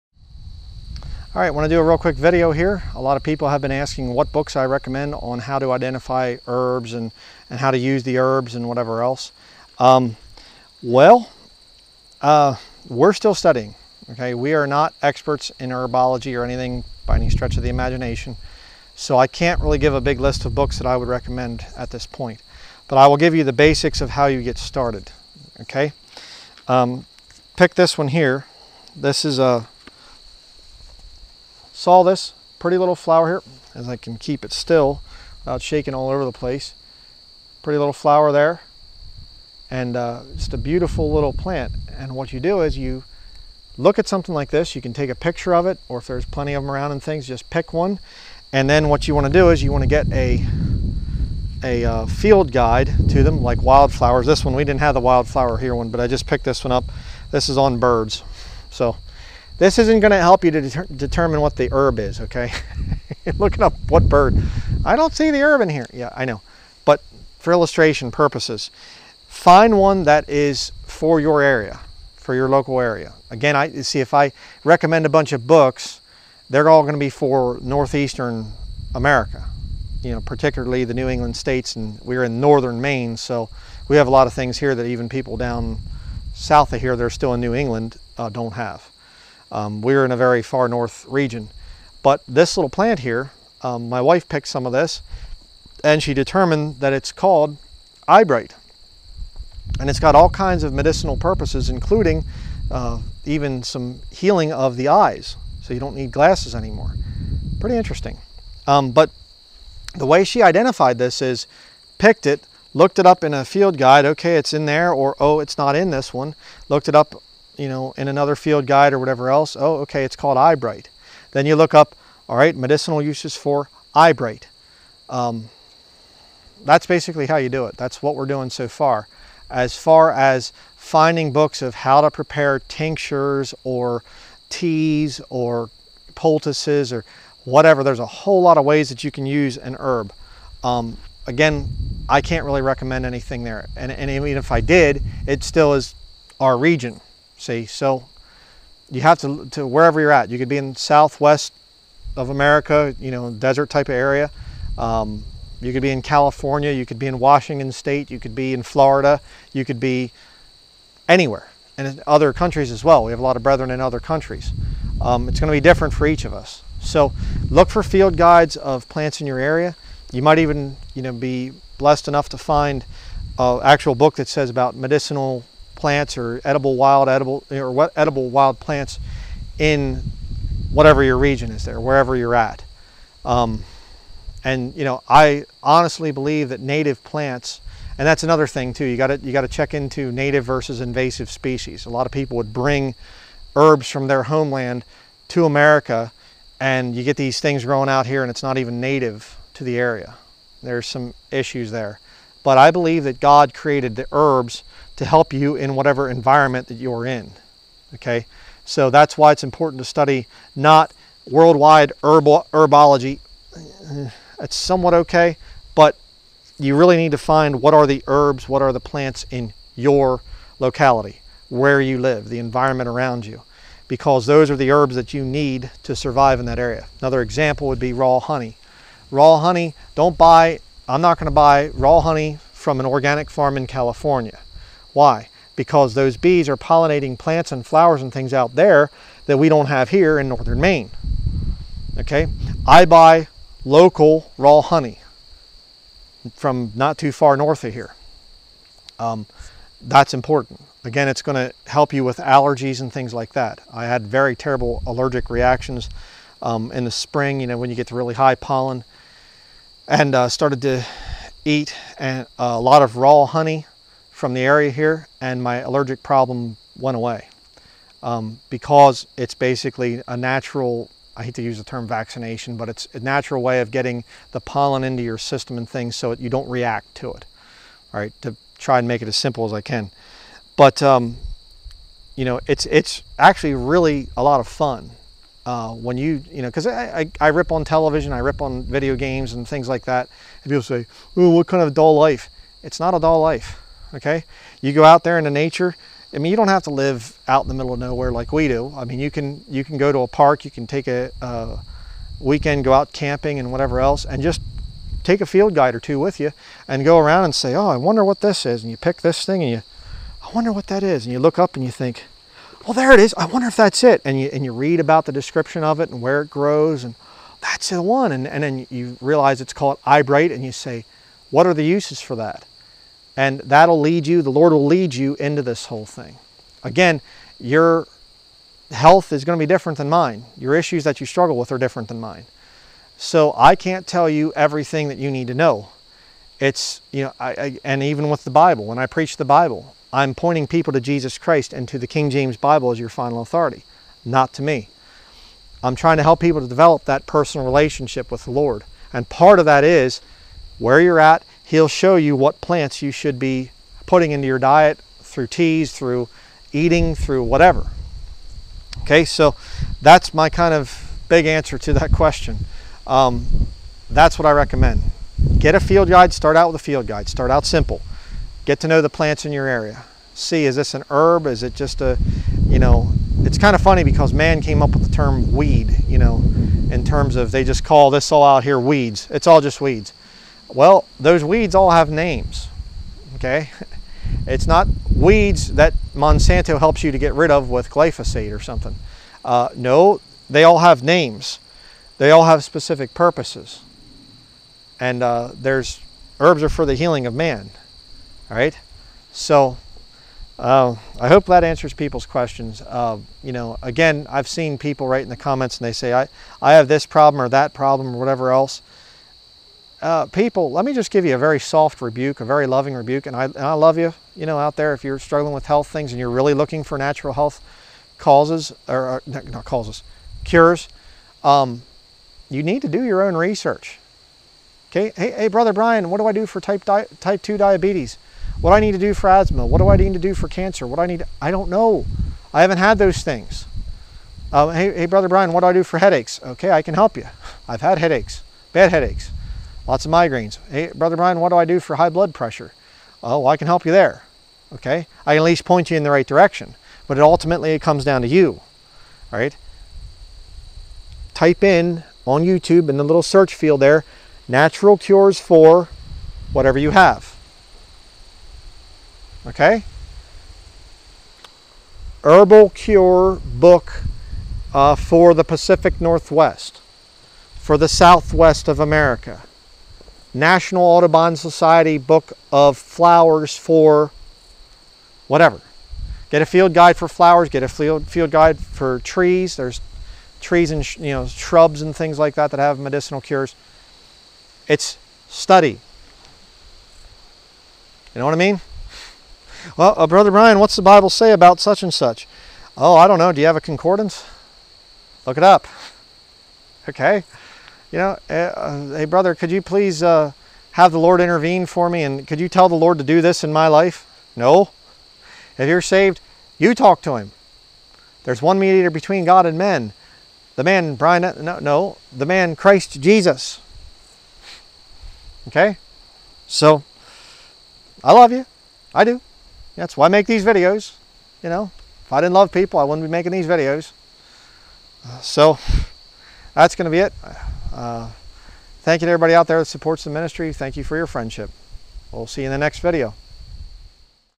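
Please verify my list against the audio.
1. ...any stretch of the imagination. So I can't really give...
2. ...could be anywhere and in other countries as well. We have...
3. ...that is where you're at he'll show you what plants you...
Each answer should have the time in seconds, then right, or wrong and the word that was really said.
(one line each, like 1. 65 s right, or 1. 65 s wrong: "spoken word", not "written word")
1. 17 s right
2. 159 s right
3. 349 s right.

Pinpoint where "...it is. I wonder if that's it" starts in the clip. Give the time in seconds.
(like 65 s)
312 s.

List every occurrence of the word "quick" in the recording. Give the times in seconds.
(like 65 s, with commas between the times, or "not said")
1 s.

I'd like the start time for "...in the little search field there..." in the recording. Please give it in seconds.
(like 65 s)
452 s.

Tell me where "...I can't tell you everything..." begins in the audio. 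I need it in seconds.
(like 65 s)
333 s.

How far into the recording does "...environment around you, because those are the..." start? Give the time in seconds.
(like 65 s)
222 s.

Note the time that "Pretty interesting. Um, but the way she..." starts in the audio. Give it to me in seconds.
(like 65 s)
107 s.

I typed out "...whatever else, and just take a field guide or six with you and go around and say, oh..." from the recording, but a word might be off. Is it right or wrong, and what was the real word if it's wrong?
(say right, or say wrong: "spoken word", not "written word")
wrong: "two", not "six".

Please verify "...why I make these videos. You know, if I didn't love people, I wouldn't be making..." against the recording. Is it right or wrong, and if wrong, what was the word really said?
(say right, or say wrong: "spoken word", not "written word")
right.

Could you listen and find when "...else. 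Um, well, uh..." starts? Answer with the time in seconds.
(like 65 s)
9 s.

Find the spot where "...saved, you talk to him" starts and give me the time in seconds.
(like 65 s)
505 s.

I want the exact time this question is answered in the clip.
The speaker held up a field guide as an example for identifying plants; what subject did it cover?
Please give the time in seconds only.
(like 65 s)
57 s.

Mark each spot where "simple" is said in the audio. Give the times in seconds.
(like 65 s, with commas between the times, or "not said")
279 s, 367 s.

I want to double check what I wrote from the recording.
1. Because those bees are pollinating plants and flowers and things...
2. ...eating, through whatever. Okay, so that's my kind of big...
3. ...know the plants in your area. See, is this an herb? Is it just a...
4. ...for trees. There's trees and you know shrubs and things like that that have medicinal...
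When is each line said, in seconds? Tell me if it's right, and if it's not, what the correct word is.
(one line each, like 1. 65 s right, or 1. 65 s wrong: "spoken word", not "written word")
1. 235 s right
2. 356 s right
3. 368 s right
4. 478 s right.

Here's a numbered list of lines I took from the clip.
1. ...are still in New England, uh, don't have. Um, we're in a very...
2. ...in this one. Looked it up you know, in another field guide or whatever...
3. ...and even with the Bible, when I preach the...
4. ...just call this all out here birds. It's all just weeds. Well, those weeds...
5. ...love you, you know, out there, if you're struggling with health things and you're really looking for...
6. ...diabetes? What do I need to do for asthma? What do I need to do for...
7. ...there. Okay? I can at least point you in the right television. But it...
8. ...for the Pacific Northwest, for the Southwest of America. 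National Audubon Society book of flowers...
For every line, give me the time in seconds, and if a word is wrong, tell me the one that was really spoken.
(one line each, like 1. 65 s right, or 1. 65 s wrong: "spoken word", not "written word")
1. 87 s right
2. 115 s right
3. 337 s right
4. 377 s wrong: "weeds", not "birds"
5. 413 s right
6. 427 s right
7. 443 s wrong: "direction", not "television"
8. 464 s right.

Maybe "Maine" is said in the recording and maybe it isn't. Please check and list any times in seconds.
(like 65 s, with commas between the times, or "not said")
82 s, 240 s.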